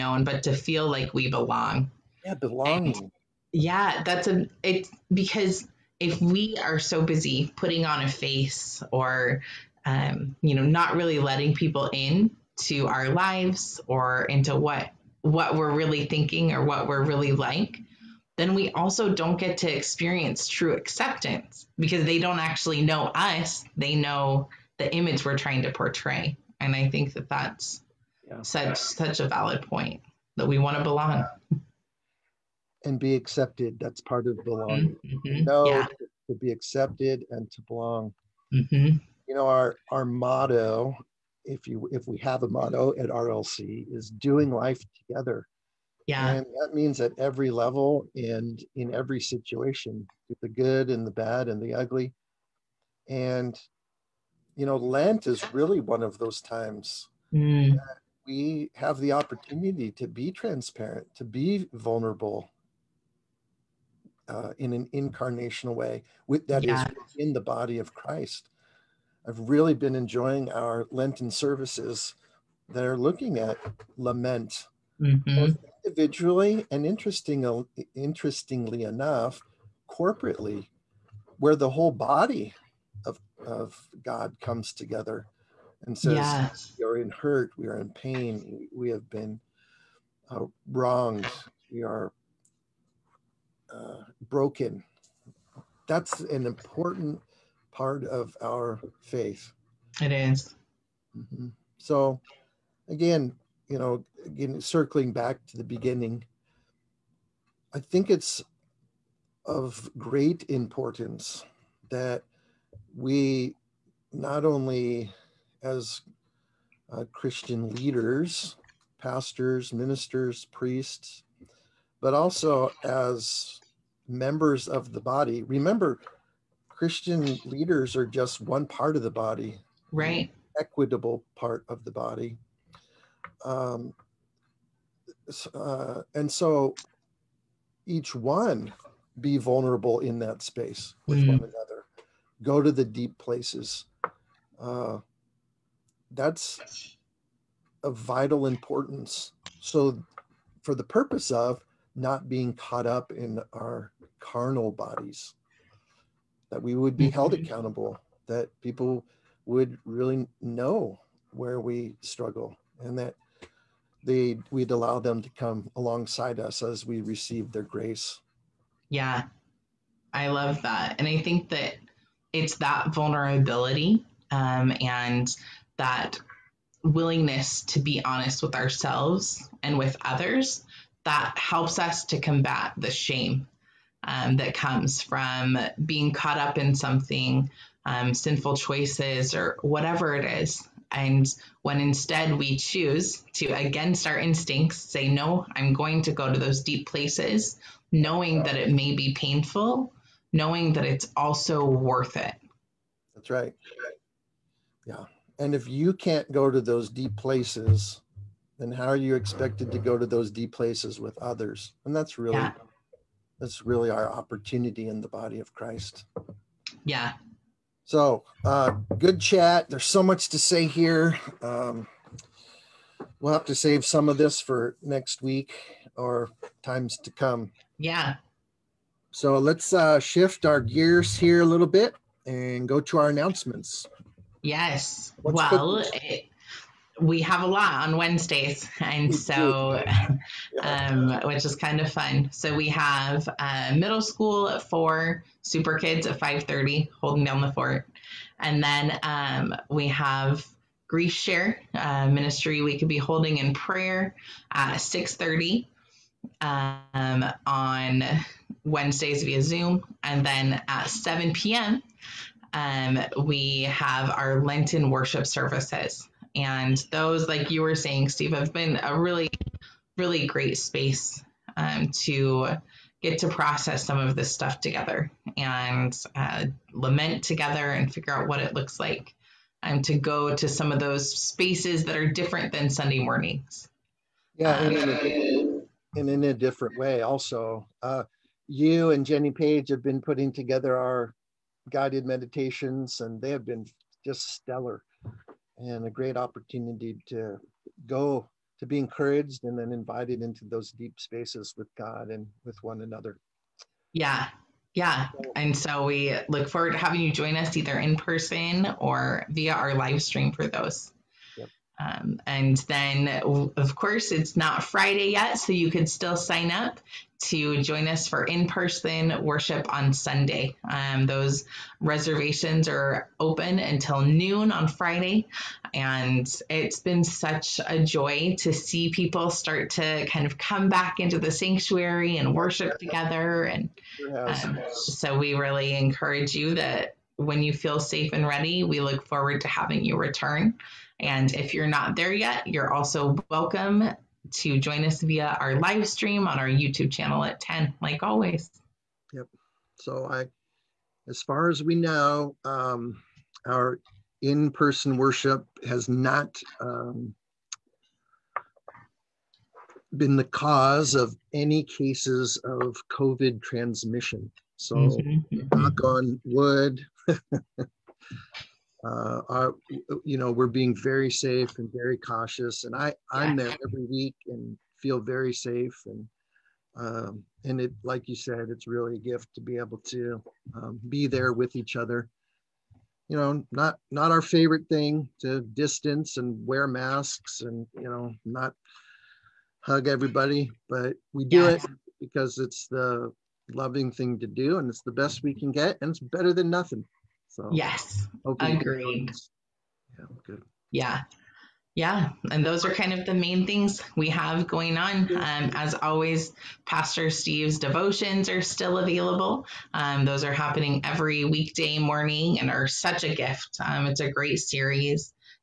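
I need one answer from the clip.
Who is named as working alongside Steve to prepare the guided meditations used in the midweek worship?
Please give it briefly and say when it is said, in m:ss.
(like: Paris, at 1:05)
Jenny Page, at 4:49.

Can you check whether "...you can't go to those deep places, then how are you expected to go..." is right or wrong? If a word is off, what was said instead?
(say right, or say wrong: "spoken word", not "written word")
right.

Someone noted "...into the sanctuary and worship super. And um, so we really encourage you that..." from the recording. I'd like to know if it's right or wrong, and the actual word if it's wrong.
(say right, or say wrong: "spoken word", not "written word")
wrong: "together", not "super".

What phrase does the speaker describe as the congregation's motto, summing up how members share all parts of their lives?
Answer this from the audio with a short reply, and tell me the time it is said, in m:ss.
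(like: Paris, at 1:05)
Doing life together, at 0:44.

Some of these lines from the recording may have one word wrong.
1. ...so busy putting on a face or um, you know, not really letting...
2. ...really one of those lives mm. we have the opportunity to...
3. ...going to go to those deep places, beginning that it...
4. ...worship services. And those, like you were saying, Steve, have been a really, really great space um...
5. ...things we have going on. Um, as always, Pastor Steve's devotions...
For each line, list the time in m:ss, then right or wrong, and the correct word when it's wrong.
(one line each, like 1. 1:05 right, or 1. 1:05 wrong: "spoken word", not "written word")
1. 0:06 right
2. 0:55 wrong: "times", not "lives"
3. 3:15 wrong: "knowing", not "beginning"
4. 4:24 right
5. 6:43 right.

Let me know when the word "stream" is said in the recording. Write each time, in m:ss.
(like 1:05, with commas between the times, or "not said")
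5:10, 5:45.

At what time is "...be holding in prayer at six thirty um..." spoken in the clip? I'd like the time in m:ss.
4:12.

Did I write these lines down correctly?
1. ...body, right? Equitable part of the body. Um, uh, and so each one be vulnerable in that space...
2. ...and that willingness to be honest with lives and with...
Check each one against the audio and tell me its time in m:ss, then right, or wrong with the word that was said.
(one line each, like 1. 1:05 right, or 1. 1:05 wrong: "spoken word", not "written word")
1. 2:09 right
2. 2:54 wrong: "ourselves", not "lives".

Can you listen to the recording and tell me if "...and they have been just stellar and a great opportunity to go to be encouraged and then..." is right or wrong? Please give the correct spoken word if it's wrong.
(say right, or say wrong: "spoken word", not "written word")
right.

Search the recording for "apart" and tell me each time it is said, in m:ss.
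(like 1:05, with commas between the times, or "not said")
not said.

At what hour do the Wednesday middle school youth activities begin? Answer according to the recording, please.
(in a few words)
4.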